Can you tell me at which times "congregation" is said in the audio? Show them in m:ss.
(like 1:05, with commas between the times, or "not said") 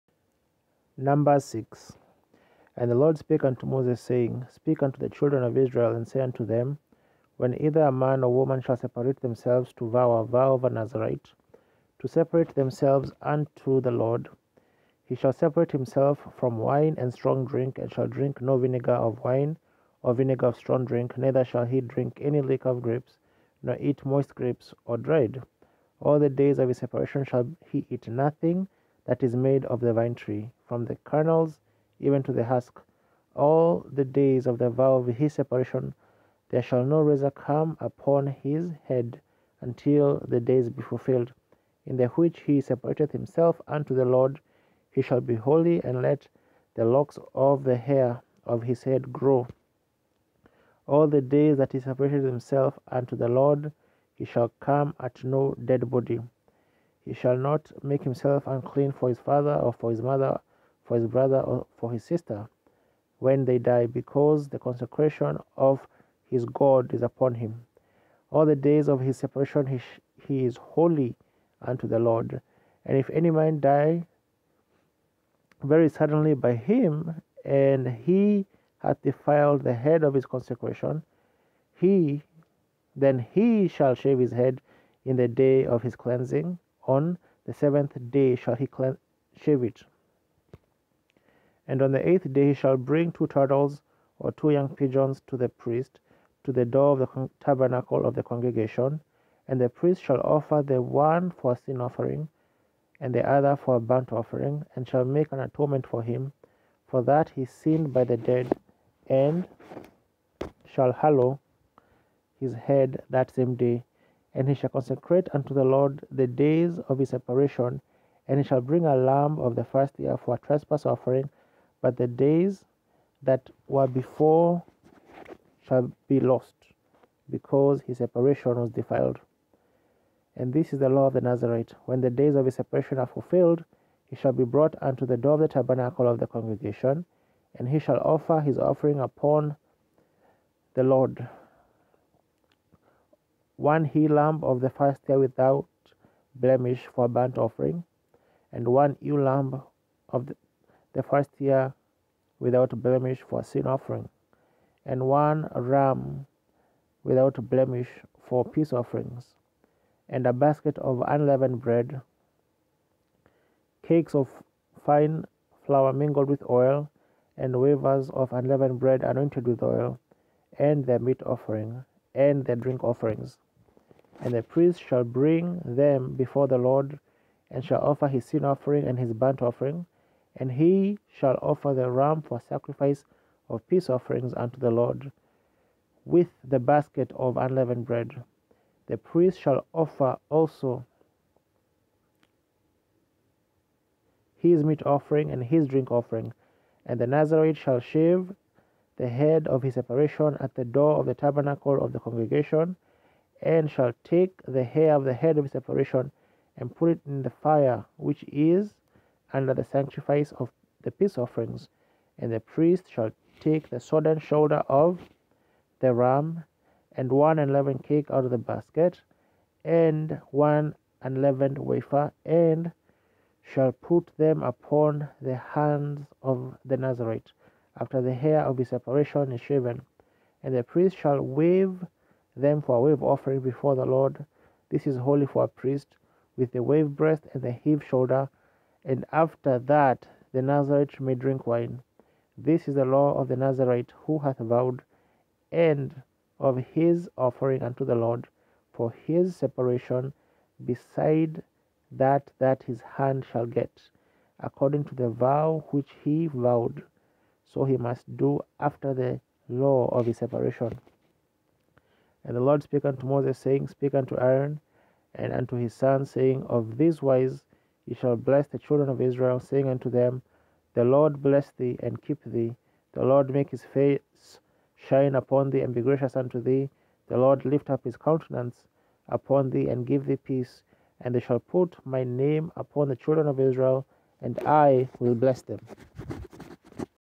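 1:38, 2:16, 3:22.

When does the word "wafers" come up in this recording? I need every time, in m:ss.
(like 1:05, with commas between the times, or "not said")
2:47, 3:41.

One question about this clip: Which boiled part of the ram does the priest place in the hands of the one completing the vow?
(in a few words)
sodden shoulder.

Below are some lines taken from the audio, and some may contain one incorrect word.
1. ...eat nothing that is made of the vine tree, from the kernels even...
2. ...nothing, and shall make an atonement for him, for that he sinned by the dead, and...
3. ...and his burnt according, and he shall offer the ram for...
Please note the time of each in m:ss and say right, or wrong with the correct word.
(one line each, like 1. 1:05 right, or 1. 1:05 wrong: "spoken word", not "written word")
1. 0:27 right
2. 1:44 wrong: "offering", not "nothing"
3. 2:58 wrong: "offering", not "according".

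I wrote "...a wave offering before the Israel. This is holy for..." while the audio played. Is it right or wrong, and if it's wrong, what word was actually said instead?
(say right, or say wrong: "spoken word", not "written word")
wrong: "Lord", not "Israel".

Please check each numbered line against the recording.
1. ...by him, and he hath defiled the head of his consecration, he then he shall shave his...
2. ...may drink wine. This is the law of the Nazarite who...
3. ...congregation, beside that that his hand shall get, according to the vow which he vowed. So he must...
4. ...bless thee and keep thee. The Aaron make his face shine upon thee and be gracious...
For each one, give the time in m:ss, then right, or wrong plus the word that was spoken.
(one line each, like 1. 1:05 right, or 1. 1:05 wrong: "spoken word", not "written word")
1. 1:16 right
2. 4:00 right
3. 4:09 wrong: "separation", not "congregation"
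4. 4:31 wrong: "Lord", not "Aaron".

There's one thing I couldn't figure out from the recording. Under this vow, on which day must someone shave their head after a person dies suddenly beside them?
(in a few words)
7th day.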